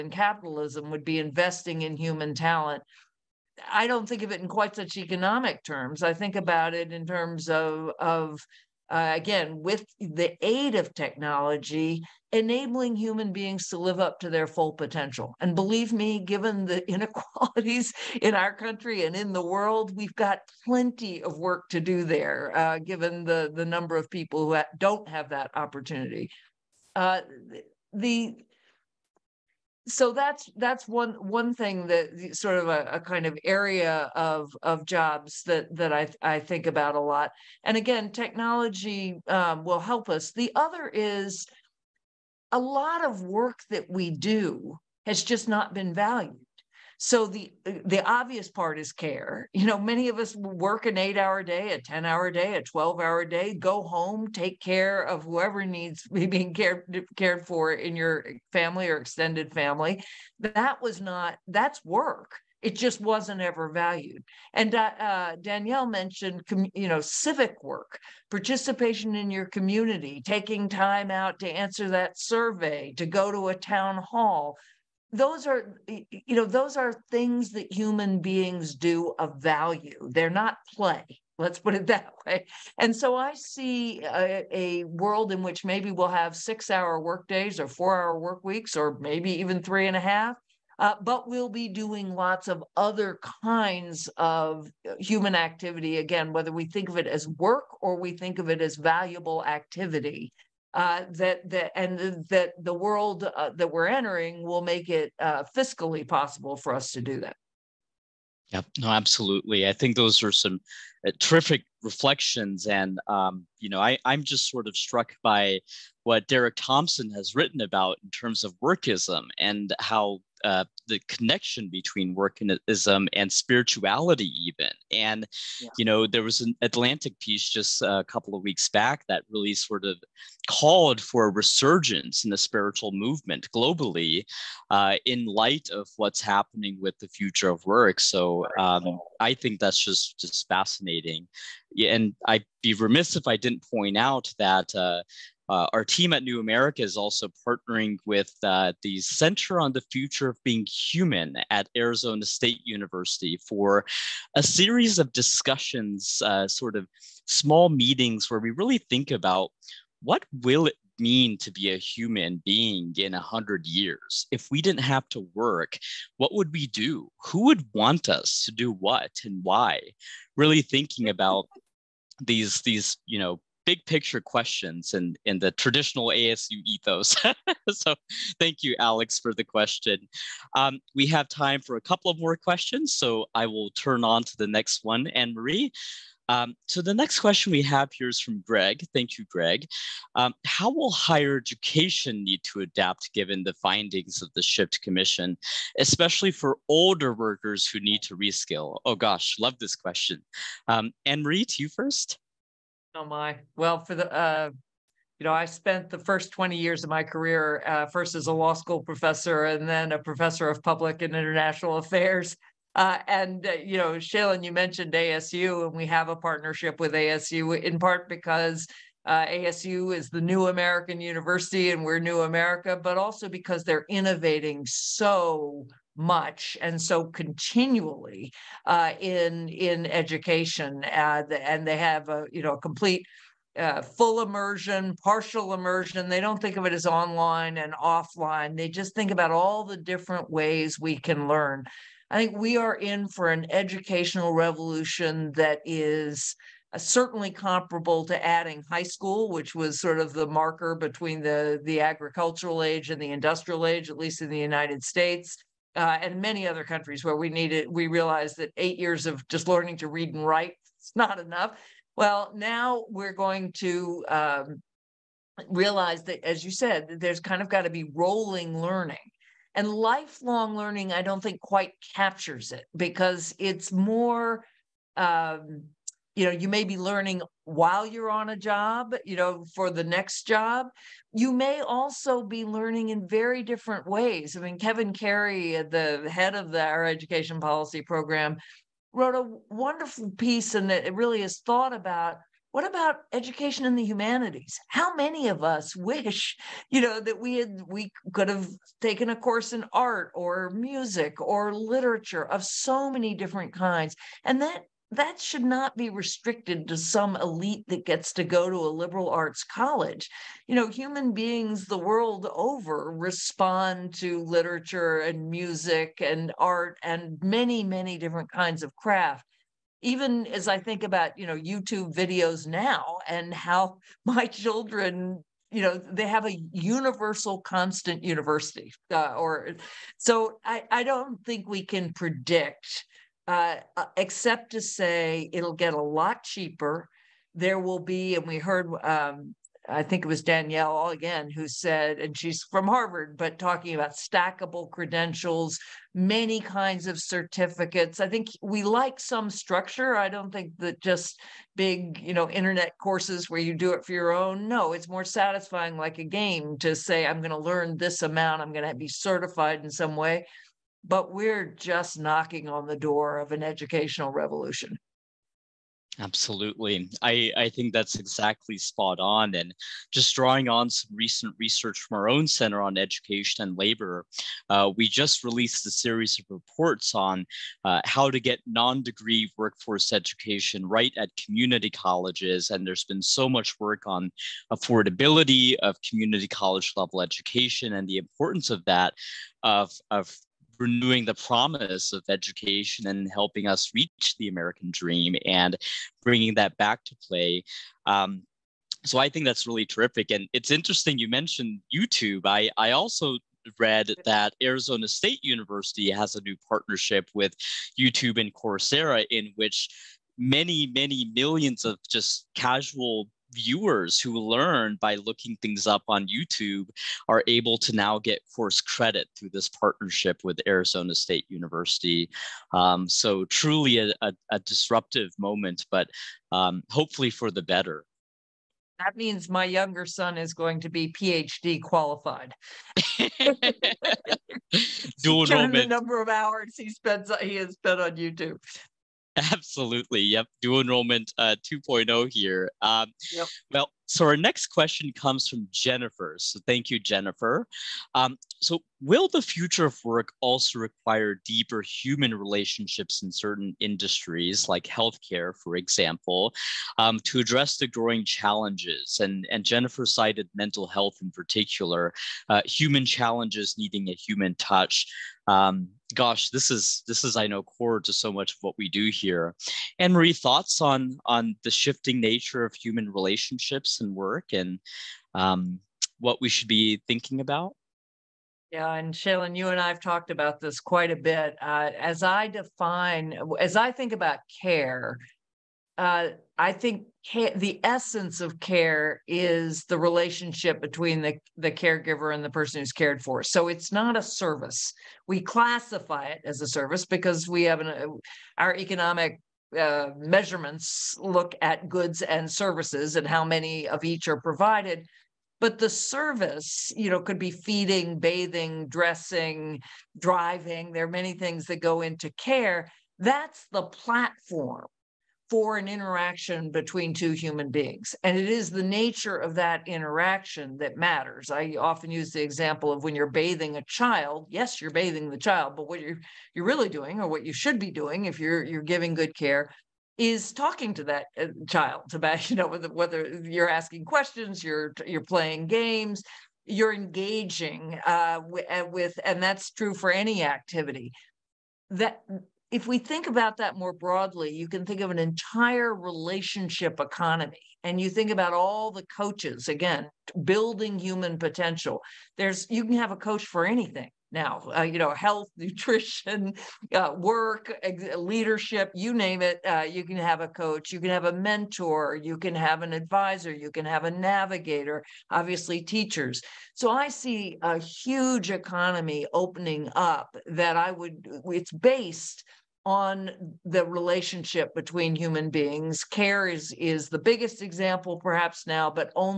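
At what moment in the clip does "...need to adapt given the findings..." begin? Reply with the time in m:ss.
3:12.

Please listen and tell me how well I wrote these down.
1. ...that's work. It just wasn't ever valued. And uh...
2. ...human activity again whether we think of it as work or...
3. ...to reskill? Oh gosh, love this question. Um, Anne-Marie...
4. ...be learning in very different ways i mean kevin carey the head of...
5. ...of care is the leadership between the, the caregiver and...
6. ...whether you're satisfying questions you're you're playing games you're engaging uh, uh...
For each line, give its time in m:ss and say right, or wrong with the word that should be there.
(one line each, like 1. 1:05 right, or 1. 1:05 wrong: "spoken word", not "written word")
1. 1:01 right
2. 1:34 right
3. 3:18 right
4. 4:42 right
5. 8:08 wrong: "relationship", not "leadership"
6. 8:52 wrong: "asking", not "satisfying".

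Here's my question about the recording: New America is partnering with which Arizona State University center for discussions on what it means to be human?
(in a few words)
Center on the Future of Being Human.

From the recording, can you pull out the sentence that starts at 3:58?
They just think about all the different ways we can learn.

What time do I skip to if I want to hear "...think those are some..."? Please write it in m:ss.
1:49.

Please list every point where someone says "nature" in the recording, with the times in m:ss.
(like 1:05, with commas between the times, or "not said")
7:52, 8:38.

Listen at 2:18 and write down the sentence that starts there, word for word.
So um, I think that's just just fascinating.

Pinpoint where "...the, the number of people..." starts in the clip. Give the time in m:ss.
0:23.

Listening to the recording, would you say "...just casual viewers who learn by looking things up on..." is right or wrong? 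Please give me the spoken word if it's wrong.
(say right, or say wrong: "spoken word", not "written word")
right.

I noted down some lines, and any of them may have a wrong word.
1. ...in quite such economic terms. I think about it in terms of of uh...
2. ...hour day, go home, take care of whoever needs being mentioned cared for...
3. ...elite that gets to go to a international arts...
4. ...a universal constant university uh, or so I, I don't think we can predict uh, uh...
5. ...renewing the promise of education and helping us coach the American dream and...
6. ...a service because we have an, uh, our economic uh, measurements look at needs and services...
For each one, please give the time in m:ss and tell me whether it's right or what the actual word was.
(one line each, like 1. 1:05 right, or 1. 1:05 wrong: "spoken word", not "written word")
1. 0:04 right
2. 0:53 wrong: "cared", not "mentioned"
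3. 5:07 wrong: "liberal", not "international"
4. 5:26 right
5. 6:30 wrong: "reach", not "coach"
6. 8:16 wrong: "goods", not "needs".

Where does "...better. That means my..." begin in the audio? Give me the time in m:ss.
7:07.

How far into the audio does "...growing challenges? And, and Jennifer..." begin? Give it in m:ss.
7:37.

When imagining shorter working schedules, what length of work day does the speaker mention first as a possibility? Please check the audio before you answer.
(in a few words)
six hour.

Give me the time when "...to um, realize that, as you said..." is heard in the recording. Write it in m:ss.
4:23.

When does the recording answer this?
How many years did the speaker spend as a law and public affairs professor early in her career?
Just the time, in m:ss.
3:26.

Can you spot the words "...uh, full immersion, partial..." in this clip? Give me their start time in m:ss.
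3:53.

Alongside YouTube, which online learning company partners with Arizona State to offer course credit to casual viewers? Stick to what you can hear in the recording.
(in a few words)
Coursera.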